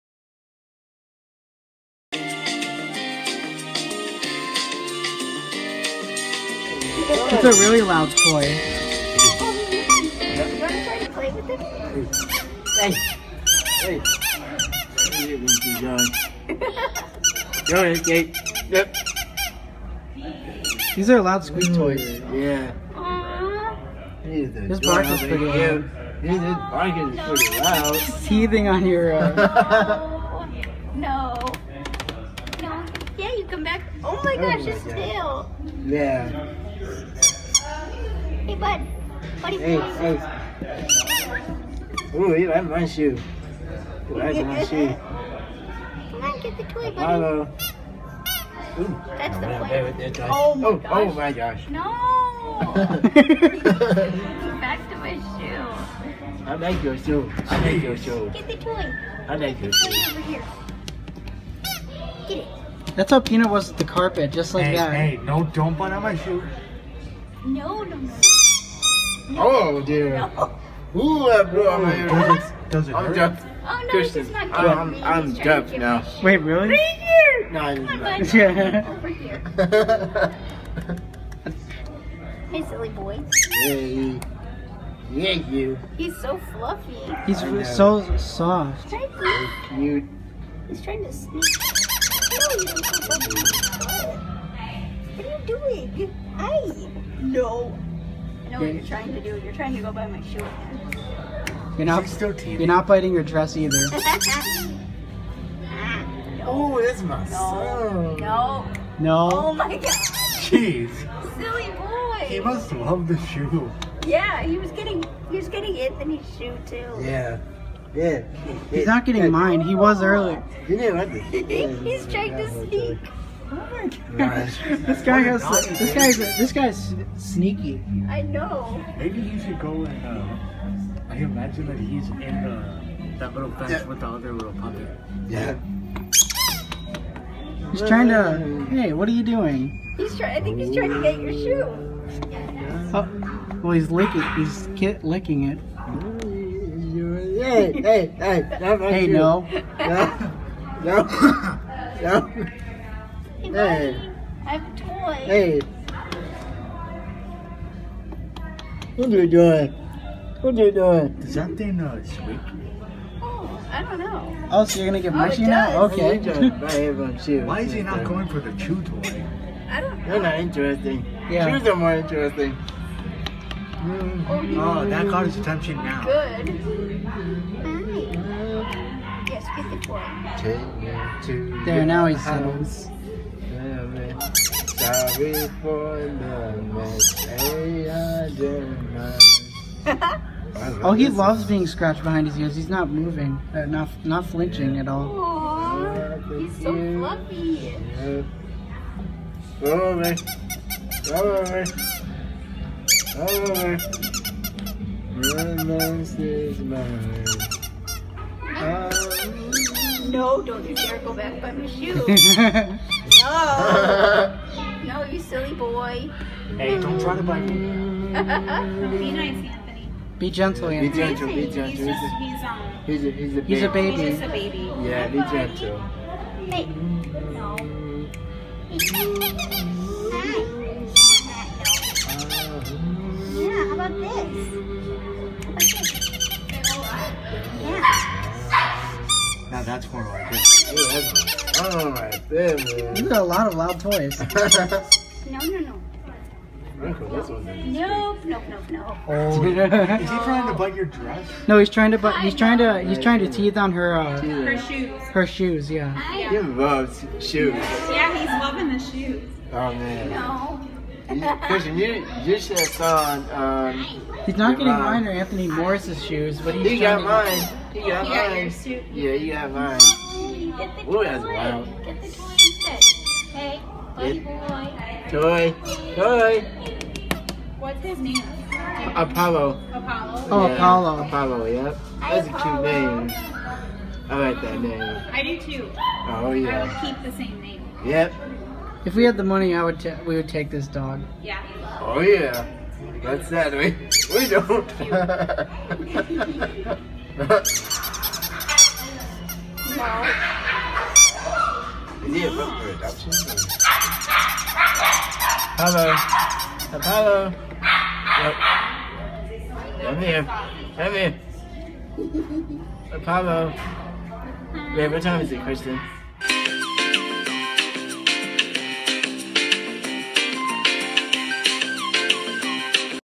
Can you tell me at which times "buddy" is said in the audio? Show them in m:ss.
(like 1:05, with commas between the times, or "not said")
0:46, 2:33, 4:33.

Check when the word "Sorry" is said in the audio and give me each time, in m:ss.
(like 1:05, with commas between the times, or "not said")
3:04.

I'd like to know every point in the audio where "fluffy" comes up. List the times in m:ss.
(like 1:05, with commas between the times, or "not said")
1:26, 3:16.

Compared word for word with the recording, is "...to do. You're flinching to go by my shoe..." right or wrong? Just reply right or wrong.
wrong.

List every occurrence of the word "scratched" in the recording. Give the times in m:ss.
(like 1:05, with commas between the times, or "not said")
3:11.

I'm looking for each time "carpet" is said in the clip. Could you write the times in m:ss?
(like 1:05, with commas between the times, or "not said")
1:03.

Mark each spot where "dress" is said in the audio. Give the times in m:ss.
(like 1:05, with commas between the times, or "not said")
1:43, 4:10.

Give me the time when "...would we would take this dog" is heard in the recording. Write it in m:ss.
4:49.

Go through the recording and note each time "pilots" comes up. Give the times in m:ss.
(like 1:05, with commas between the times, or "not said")
not said.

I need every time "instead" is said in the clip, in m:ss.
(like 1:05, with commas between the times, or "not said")
4:32.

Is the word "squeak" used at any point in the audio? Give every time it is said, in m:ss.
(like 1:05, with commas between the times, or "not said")
0:21, 2:42.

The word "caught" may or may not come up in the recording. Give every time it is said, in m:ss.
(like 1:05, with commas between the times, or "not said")
2:55.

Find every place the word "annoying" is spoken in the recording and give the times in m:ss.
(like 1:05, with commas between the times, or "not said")
not said.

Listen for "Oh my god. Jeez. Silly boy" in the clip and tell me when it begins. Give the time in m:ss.
1:49.